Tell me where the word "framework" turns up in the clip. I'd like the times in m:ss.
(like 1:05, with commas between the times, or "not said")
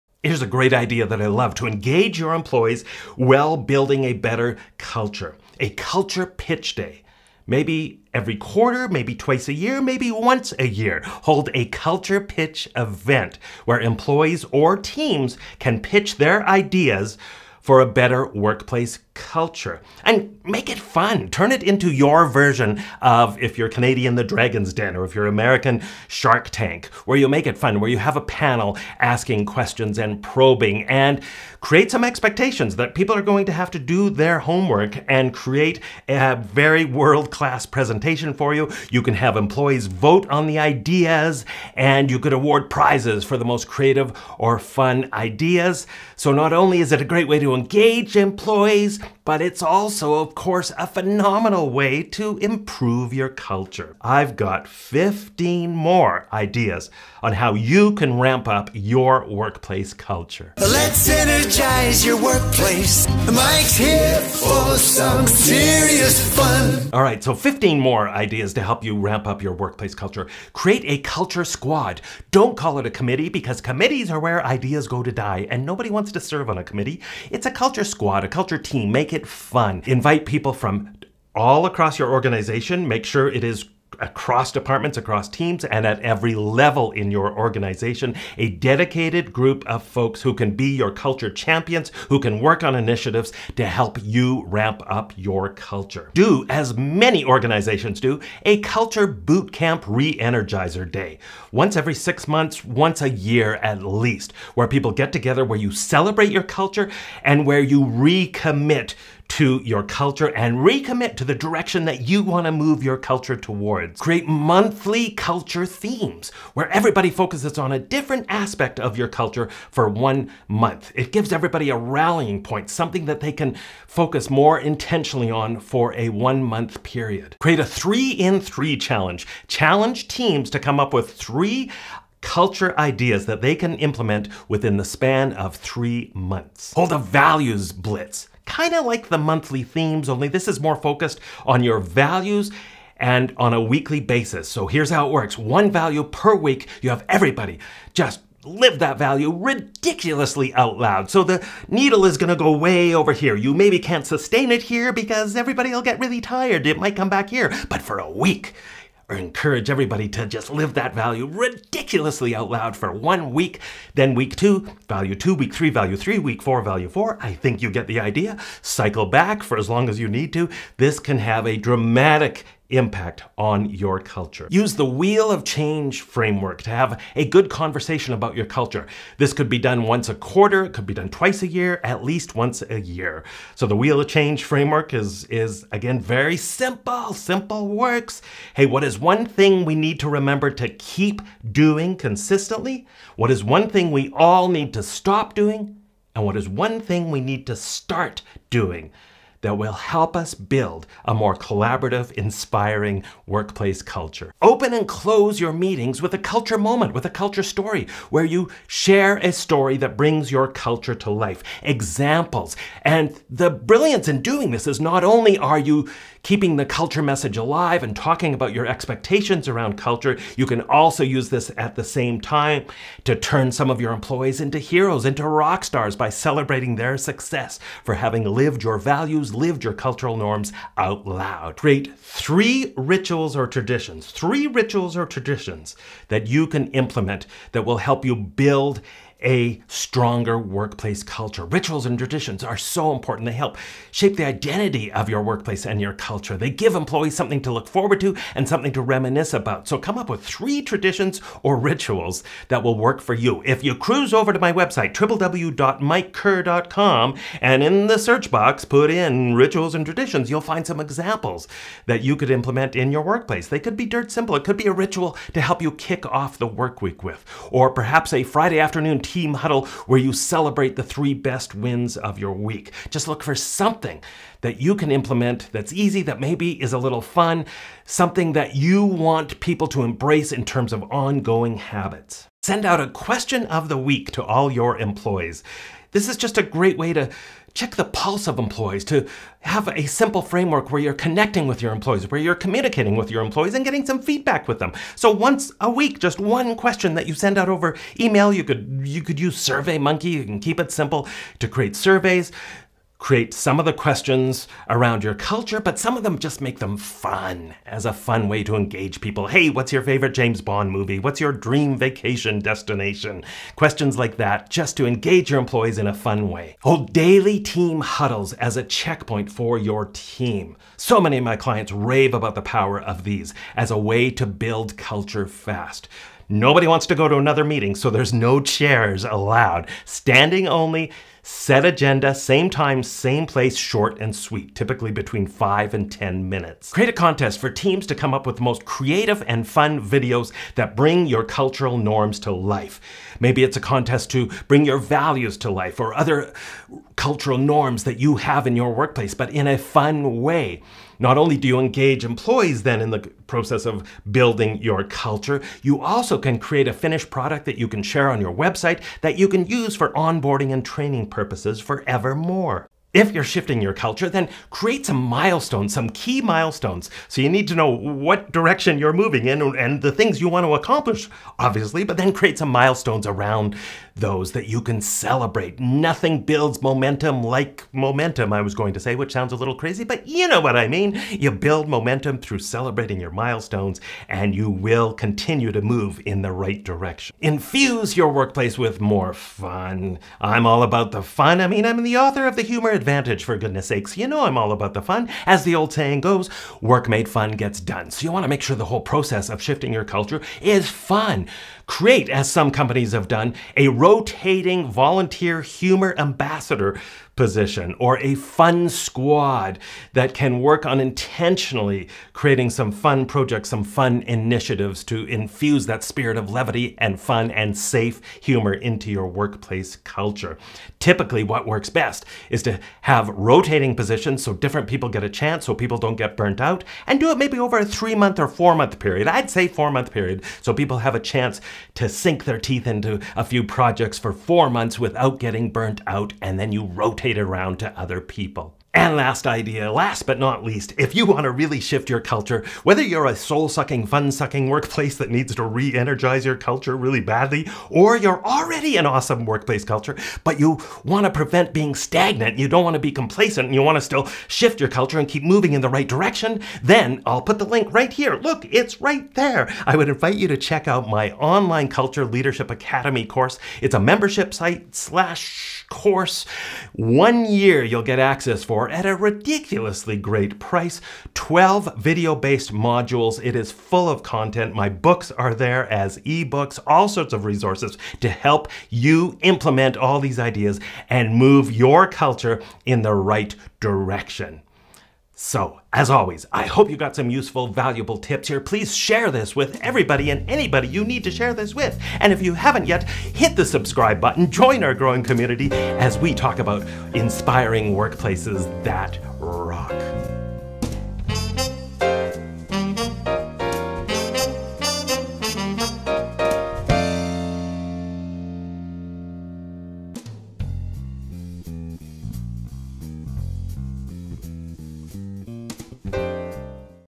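2:56, 3:04, 4:50.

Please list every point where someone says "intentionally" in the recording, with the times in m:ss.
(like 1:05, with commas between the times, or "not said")
2:04, 6:50.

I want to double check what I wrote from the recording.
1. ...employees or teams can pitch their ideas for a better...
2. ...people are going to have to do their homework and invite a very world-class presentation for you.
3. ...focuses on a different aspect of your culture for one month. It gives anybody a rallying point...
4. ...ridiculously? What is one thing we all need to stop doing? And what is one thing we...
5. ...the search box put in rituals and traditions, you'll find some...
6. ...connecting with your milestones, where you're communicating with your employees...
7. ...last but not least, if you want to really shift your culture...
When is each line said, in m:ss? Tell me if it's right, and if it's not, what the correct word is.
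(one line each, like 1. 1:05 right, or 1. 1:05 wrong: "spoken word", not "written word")
1. 0:13 right
2. 0:32 wrong: "create", not "invite"
3. 1:57 wrong: "everybody", not "anybody"
4. 3:11 wrong: "consistently", not "ridiculously"
5. 4:17 right
6. 4:50 wrong: "employees", not "milestones"
7. 7:19 right.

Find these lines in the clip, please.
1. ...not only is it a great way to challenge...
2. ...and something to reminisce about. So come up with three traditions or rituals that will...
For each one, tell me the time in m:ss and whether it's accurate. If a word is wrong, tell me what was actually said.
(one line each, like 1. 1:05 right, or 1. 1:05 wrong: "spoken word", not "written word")
1. 0:46 wrong: "engage", not "challenge"
2. 4:08 right.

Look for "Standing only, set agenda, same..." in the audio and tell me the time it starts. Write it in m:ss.
5:29.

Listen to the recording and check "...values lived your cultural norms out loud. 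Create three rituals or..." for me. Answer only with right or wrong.
right.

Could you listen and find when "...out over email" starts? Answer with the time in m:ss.
4:57.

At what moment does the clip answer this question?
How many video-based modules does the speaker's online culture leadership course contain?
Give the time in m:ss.
7:51.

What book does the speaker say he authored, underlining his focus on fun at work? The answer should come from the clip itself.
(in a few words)
The Humor Advantage.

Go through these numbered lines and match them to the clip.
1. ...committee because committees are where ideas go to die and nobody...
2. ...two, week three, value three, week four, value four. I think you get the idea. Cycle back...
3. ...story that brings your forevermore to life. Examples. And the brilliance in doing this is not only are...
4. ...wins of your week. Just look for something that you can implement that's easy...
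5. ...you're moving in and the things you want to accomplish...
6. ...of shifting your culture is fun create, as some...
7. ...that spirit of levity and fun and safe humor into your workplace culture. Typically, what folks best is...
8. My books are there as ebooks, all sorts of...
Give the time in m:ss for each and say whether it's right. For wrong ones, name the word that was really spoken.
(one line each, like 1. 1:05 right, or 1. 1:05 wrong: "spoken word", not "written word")
1. 1:12 right
2. 2:45 right
3. 3:29 wrong: "culture", not "forevermore"
4. 4:31 right
5. 6:08 right
6. 6:39 right
7. 6:55 wrong: "works", not "folks"
8. 7:54 right.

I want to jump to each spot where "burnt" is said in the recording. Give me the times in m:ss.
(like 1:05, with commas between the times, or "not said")
7:06, 7:15.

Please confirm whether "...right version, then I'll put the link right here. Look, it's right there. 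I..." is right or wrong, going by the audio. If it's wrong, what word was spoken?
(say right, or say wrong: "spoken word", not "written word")
wrong: "direction", not "version".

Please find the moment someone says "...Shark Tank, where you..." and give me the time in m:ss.
0:26.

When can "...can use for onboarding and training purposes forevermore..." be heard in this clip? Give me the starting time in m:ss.
5:59.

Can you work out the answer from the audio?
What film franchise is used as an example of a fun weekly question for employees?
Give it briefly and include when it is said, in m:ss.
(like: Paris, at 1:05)
James Bond, at 5:10.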